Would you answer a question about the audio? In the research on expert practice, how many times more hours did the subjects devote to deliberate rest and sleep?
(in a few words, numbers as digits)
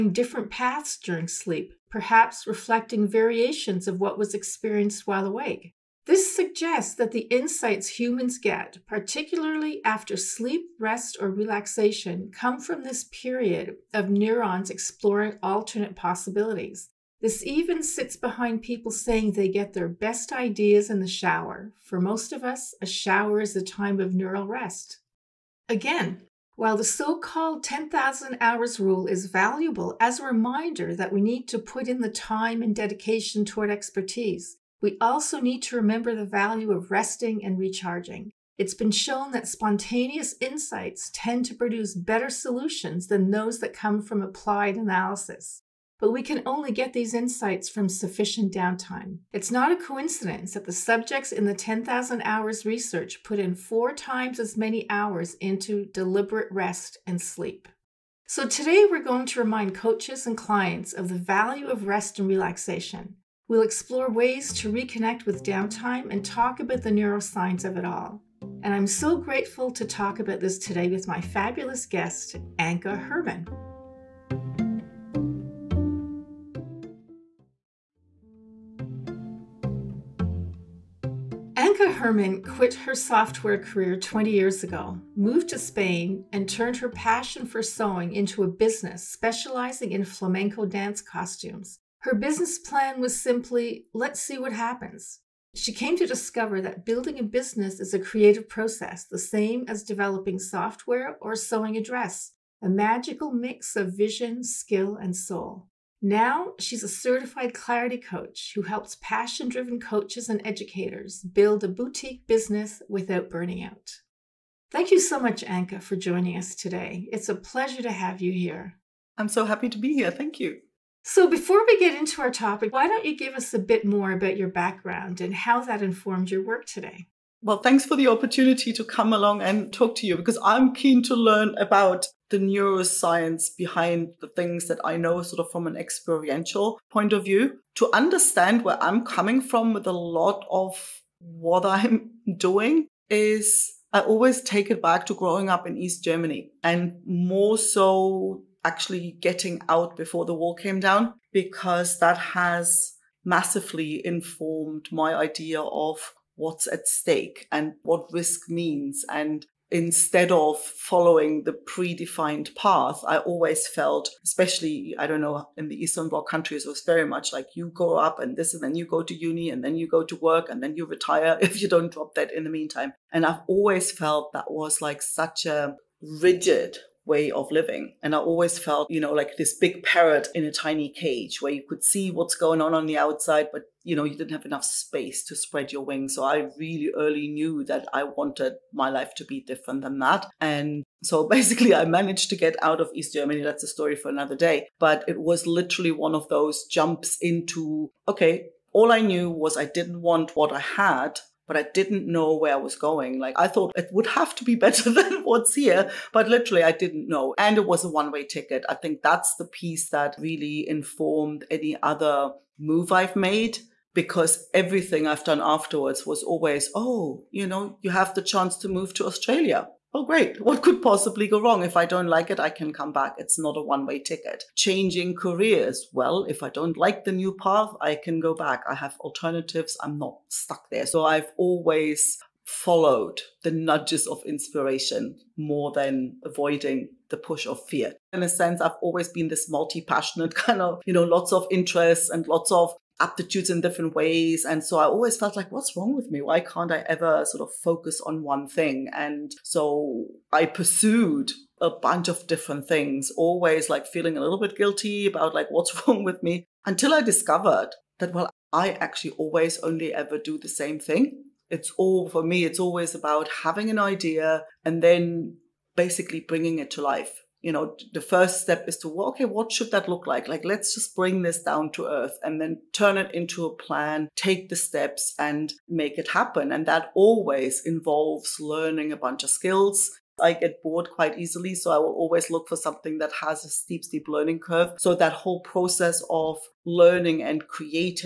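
4.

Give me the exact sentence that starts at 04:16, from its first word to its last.
Until I discovered that, well, I actually always only ever do the same thing.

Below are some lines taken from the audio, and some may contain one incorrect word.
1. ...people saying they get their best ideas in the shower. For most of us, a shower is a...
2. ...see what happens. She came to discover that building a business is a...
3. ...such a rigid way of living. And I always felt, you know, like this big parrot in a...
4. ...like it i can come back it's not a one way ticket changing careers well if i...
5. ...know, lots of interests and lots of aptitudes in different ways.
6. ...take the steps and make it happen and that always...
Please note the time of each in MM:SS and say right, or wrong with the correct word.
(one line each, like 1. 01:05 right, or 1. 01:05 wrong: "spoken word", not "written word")
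1. 00:18 right
2. 01:34 right
3. 02:55 right
4. 03:42 right
5. 04:00 right
6. 04:34 right.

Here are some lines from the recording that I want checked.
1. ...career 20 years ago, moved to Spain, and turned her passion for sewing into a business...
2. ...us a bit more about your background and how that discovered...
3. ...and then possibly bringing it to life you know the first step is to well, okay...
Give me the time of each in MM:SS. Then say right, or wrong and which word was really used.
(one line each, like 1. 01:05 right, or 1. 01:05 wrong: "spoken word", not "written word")
1. 01:23 right
2. 02:03 wrong: "informed", not "discovered"
3. 04:24 wrong: "basically", not "possibly".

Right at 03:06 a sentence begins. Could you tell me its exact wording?
So I really early knew that I wanted my life to be different than that.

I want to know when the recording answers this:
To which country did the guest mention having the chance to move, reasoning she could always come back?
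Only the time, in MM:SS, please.
03:39.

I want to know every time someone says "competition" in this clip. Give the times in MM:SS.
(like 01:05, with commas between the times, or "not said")
not said.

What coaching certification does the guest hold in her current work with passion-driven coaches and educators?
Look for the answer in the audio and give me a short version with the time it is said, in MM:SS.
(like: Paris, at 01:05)
clarity coach, at 01:47.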